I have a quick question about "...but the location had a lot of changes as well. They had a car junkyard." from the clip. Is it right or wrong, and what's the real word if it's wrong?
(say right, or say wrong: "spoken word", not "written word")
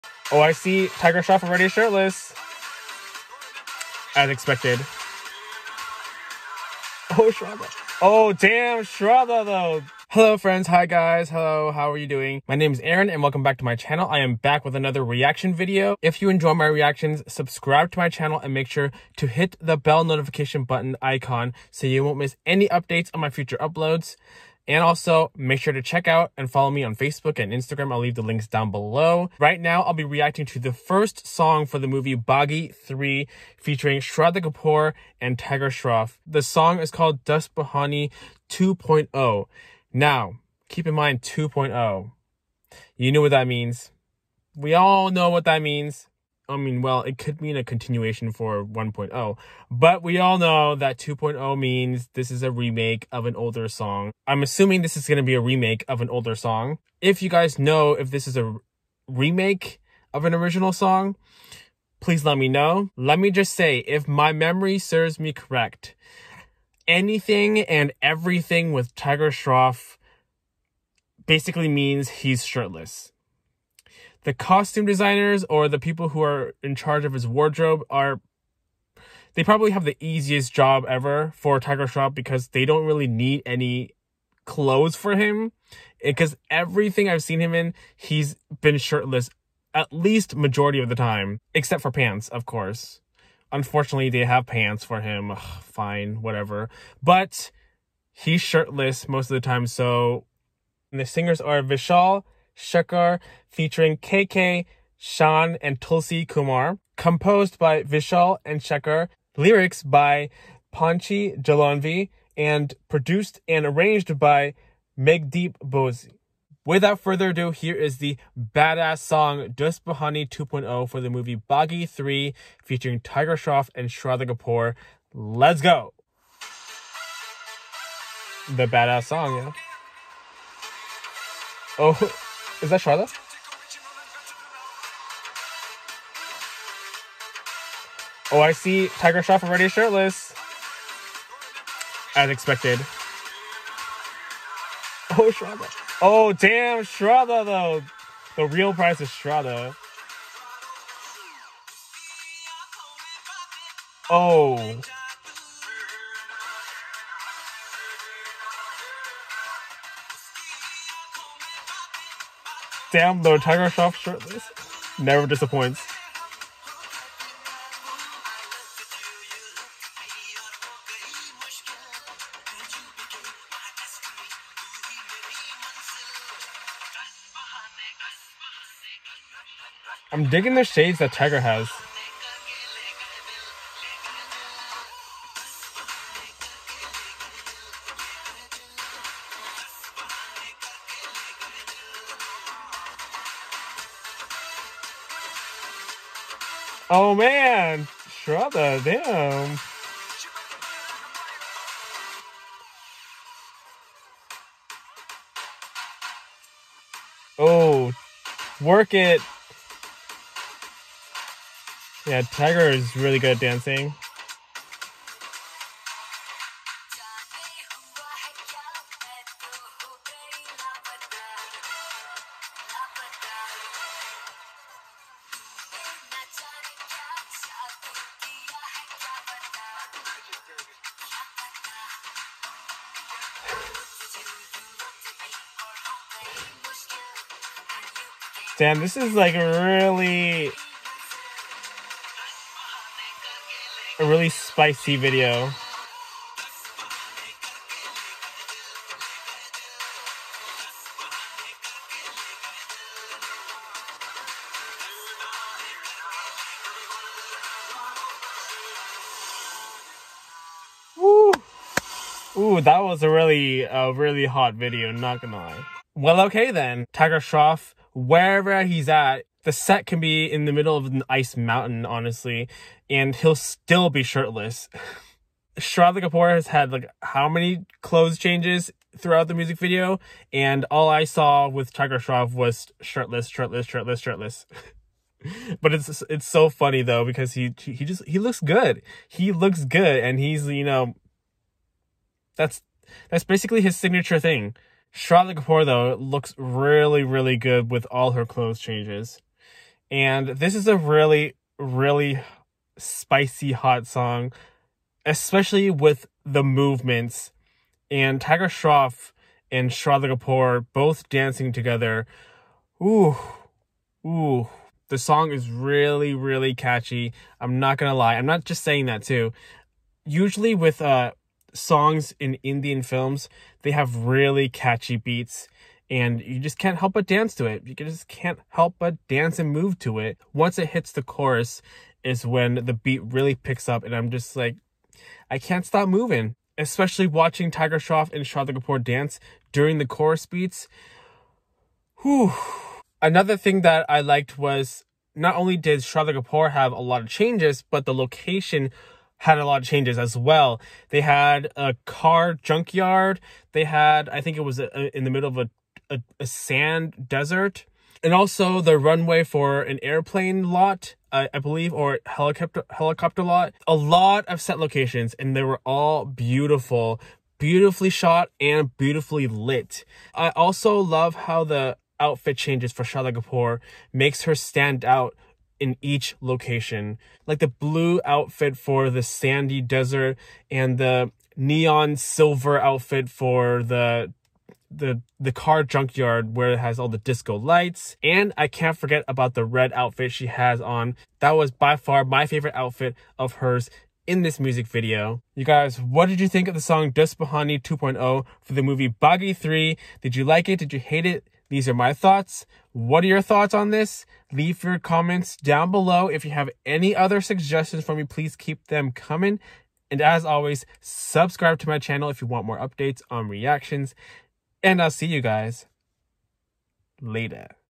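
right.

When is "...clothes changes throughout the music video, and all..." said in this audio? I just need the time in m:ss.
4:37.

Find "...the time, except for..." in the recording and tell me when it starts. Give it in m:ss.
1:30.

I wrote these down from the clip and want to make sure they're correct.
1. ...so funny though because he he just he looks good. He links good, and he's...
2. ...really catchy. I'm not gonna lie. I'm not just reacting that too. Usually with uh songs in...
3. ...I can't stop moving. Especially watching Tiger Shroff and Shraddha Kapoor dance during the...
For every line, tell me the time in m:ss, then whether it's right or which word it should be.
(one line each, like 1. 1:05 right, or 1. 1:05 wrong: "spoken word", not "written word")
1. 4:46 wrong: "looks", not "links"
2. 5:16 wrong: "saying", not "reacting"
3. 5:35 right.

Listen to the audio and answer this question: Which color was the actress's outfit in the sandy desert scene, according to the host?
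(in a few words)
blue.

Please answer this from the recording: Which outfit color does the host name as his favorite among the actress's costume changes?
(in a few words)
red.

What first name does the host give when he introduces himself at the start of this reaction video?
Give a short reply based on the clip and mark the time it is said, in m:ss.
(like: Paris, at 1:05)
Aaron, at 0:12.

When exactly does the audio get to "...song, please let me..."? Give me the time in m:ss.
1:00.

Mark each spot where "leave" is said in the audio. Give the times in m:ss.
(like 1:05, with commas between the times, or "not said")
0:27, 6:44.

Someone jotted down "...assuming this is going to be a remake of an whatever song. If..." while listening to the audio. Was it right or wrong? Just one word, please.
wrong.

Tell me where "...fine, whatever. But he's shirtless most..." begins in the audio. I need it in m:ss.
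1:35.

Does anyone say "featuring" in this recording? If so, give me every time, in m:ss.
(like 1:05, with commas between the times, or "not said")
0:33, 1:43, 2:02.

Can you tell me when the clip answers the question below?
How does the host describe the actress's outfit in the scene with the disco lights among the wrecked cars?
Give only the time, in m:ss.
6:21.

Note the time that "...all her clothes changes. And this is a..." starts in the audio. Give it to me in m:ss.
4:57.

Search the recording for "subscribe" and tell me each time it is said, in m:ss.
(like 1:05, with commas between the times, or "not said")
0:17, 6:50.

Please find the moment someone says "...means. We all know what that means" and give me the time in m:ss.
0:43.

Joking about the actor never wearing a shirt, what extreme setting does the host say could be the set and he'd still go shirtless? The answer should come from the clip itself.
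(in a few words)
an ice mountain.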